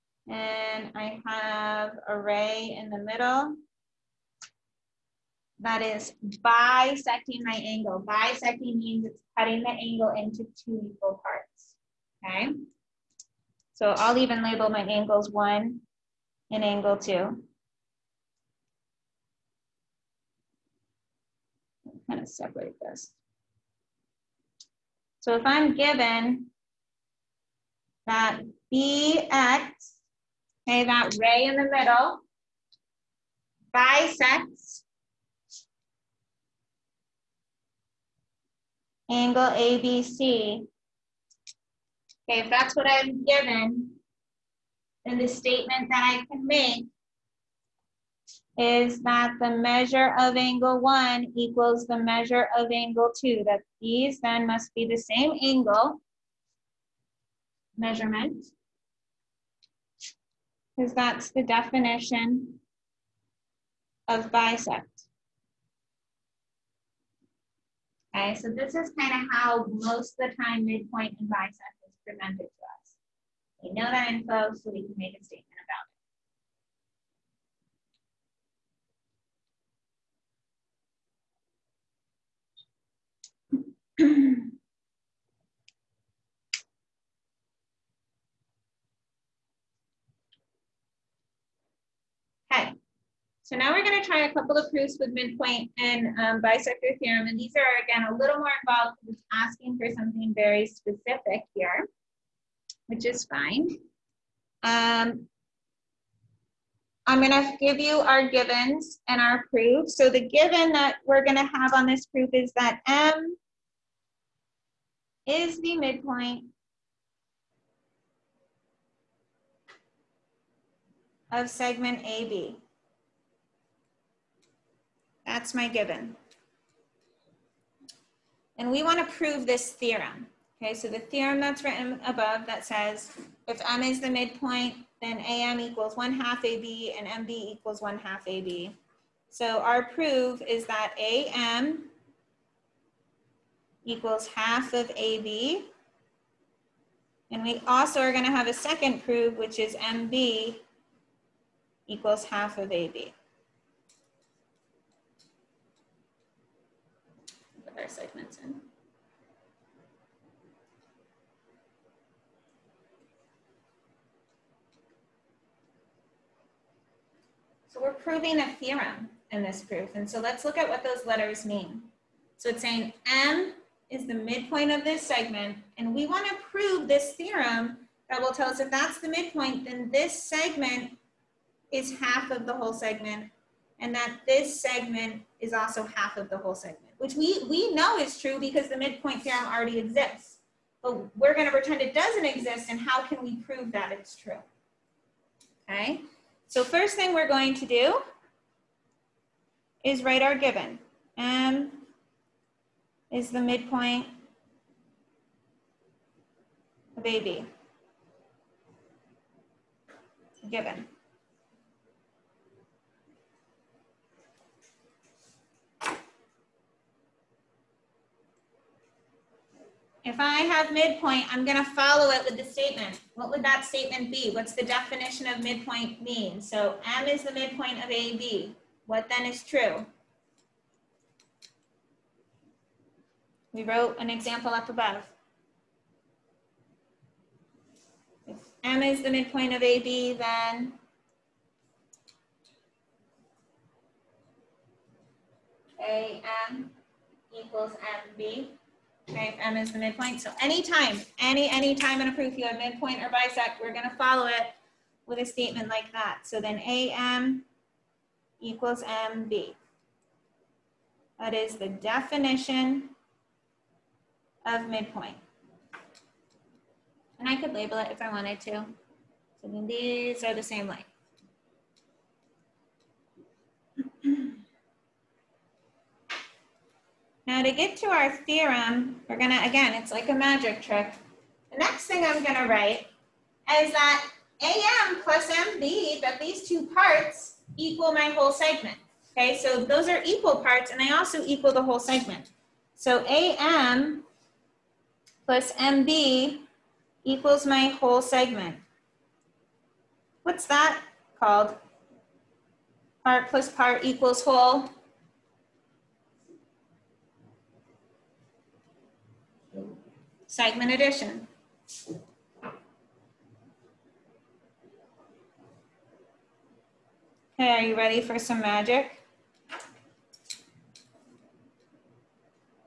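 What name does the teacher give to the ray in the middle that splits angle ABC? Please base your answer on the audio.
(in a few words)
BX.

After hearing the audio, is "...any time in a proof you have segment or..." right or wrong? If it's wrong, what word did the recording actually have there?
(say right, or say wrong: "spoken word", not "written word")
wrong: "midpoint", not "segment".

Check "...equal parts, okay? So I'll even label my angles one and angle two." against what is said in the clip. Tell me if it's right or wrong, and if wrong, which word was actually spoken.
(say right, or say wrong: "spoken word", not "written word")
right.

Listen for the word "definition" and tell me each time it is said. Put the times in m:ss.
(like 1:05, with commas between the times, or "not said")
1:01, 3:44, 4:21.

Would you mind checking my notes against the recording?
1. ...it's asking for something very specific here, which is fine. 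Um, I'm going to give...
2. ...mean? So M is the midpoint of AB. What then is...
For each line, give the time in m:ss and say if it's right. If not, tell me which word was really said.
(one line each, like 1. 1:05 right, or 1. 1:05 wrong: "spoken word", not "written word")
1. 1:39 right
2. 3:46 right.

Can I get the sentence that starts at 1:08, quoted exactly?
Okay, so this is kind of how most of the time midpoint and bisect is presented to us.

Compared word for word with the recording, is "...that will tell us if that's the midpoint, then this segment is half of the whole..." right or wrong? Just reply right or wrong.
right.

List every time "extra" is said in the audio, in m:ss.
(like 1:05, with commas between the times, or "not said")
not said.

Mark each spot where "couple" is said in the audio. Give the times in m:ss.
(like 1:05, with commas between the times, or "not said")
1:34.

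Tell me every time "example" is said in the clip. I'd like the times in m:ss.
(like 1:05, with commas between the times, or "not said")
3:54.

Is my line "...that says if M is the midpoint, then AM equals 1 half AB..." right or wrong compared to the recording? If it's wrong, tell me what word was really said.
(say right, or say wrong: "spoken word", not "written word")
right.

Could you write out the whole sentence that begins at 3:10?
But we're going to pretend it doesn't exist, and how can we prove that it's true?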